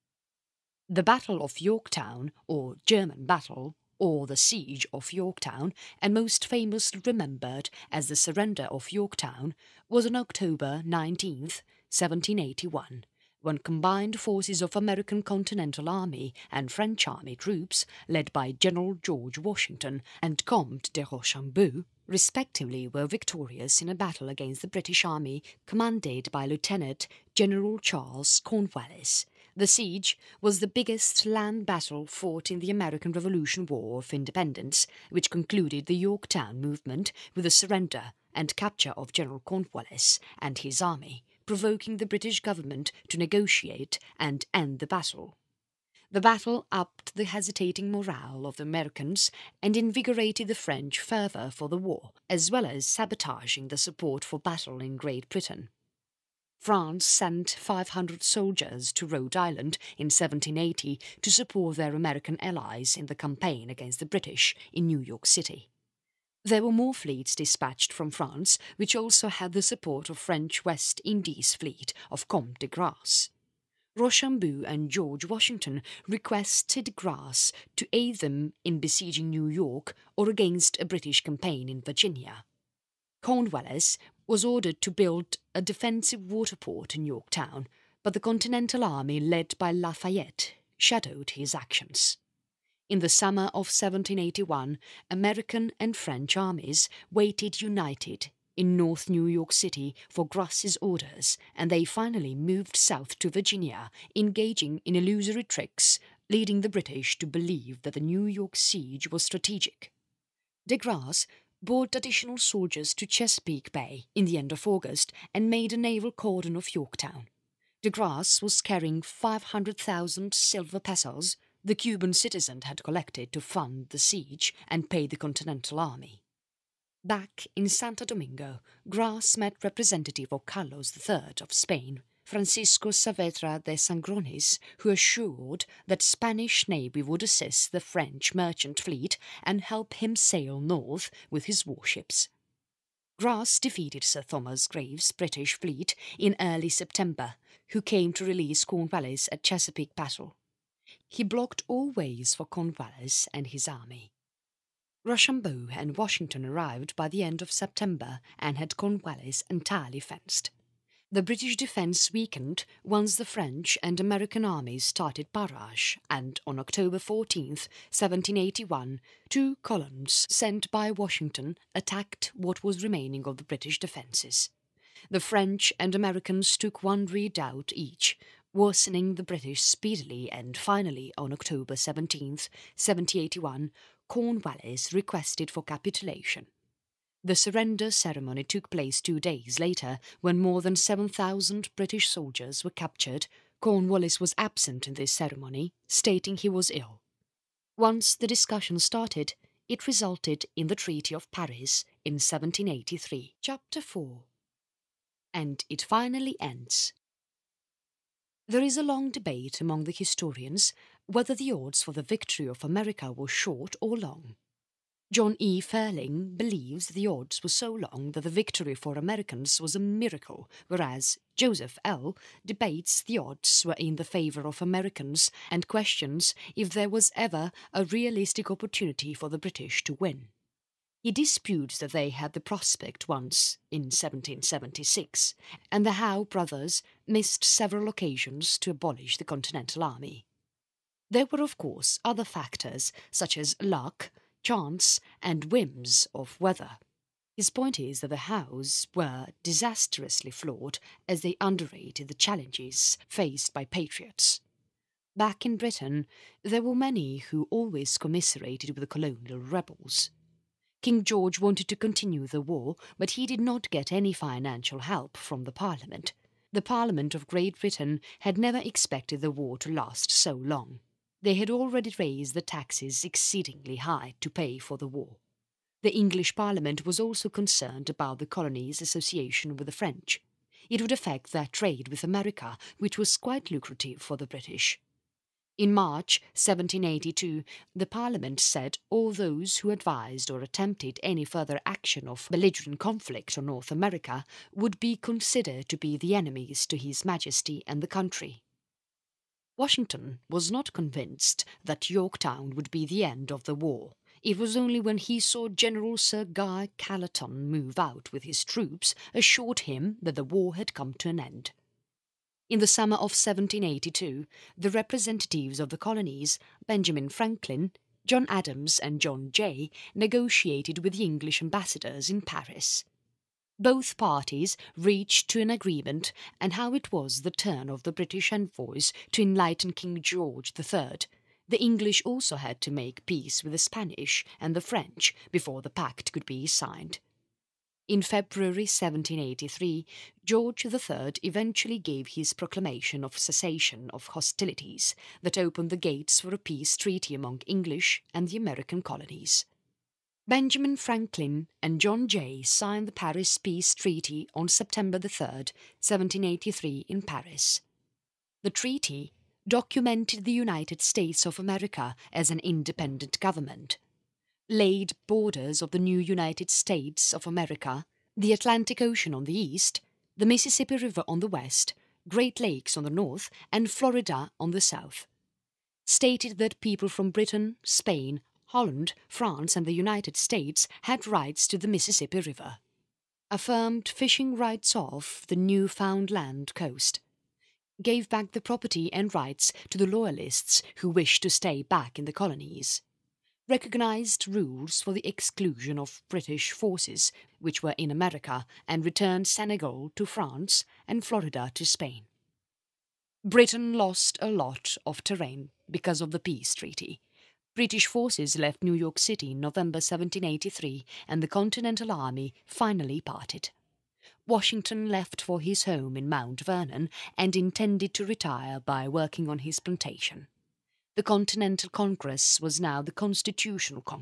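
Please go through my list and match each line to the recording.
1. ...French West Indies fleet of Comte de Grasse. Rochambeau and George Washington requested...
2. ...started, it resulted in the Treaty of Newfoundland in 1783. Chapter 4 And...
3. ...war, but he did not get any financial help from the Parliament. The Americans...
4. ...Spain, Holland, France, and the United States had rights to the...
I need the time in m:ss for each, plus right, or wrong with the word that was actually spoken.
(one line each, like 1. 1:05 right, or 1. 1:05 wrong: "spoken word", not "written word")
1. 1:10 right
2. 3:18 wrong: "Paris", not "Newfoundland"
3. 4:22 wrong: "Parliament", not "Americans"
4. 6:17 right.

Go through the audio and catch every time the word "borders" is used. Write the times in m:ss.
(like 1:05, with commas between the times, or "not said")
6:05.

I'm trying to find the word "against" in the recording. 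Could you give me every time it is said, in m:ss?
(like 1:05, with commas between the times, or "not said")
0:24, 1:03, 1:20.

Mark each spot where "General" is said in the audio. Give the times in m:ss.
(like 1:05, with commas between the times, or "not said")
0:18, 0:27, 0:39, 5:05.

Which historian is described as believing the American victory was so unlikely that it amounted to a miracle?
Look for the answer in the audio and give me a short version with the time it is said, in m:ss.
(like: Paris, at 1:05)
John E. Ferling, at 3:35.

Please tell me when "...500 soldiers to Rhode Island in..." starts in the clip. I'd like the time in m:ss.
0:57.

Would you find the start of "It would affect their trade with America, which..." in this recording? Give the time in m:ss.
4:40.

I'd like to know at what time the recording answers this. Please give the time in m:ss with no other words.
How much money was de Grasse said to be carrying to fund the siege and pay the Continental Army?
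1:59.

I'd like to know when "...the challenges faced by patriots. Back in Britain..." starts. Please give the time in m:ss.
4:12.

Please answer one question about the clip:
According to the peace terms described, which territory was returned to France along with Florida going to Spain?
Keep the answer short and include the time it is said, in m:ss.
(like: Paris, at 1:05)
Senegal, at 6:39.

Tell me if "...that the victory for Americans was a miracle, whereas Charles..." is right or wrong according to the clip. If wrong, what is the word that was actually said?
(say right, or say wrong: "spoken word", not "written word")
wrong: "Joseph", not "Charles".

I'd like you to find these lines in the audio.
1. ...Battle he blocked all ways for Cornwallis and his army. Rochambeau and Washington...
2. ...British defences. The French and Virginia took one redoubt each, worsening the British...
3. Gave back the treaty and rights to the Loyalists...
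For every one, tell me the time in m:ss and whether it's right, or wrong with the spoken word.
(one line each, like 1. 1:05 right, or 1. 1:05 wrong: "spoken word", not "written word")
1. 2:29 right
2. 2:53 wrong: "Americans", not "Virginia"
3. 6:27 wrong: "property", not "treaty".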